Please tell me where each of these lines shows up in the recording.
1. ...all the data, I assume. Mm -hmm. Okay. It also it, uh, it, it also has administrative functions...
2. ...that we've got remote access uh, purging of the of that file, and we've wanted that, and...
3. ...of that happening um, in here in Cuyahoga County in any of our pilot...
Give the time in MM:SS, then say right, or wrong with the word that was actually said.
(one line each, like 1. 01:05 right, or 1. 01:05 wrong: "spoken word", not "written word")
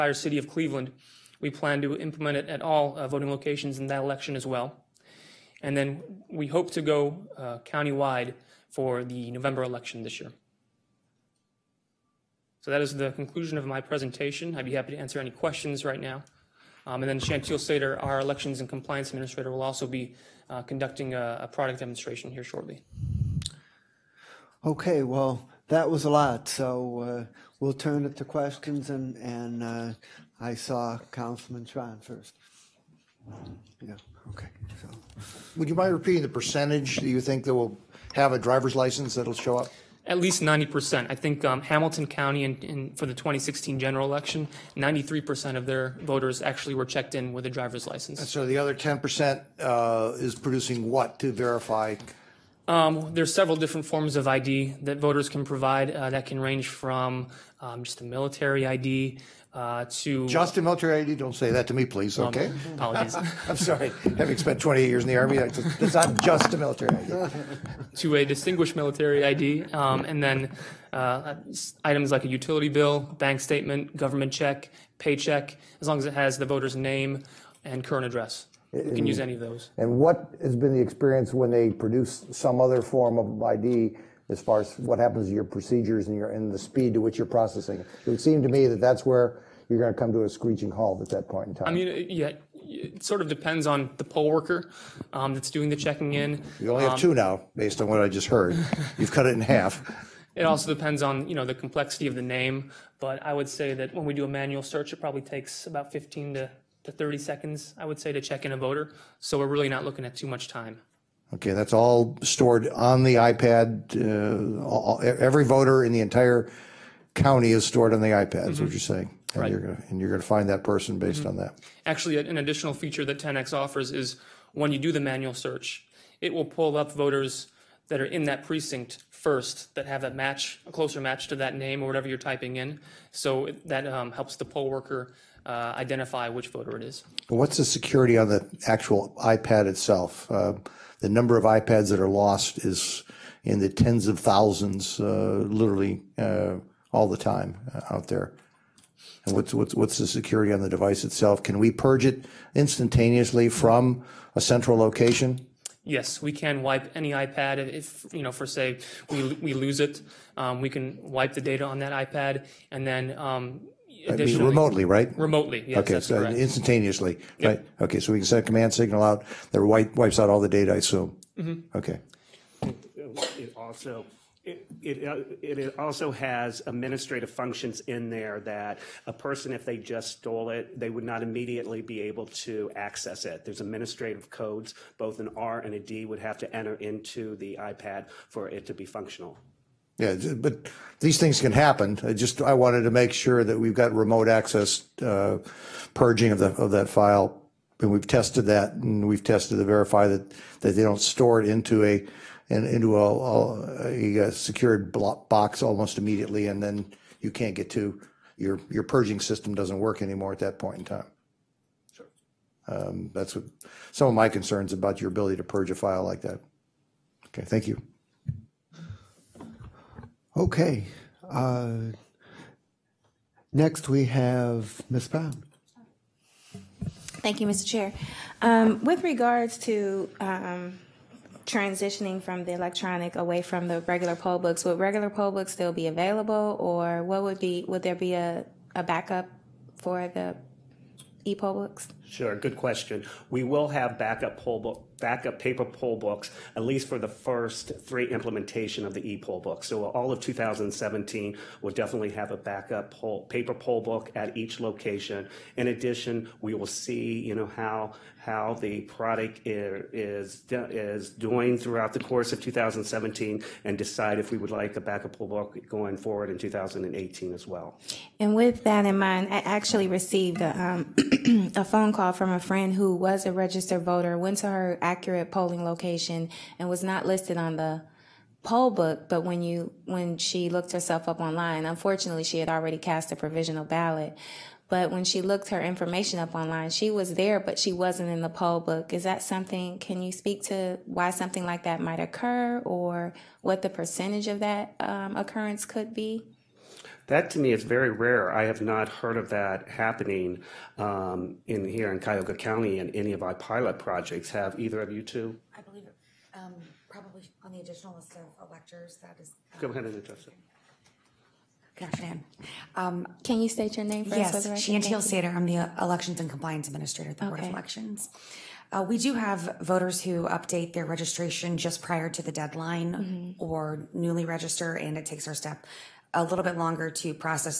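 1. 02:50 right
2. 03:13 wrong: "tested", not "wanted"
3. 04:59 right.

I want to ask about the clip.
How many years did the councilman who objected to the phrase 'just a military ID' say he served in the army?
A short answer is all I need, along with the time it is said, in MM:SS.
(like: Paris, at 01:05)
28, at 01:04.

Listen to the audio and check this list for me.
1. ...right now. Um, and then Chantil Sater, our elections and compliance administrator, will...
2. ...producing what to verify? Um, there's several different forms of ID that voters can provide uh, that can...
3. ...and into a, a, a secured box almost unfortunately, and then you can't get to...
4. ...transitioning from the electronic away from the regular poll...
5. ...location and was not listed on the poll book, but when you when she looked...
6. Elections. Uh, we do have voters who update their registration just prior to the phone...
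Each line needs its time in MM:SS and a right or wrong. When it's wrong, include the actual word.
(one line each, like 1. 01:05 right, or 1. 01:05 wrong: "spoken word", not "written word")
1. 00:15 right
2. 00:50 right
3. 03:22 wrong: "immediately", not "unfortunately"
4. 03:51 right
5. 04:35 right
6. 05:17 wrong: "deadline", not "phone".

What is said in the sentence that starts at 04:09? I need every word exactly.
So all of 2017, we'll definitely have a backup poll, paper poll book at each location.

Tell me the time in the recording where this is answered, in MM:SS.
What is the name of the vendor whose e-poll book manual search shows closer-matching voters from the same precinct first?
02:03.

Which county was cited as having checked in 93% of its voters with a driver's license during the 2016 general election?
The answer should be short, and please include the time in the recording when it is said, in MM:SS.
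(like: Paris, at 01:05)
Hamilton County, at 00:41.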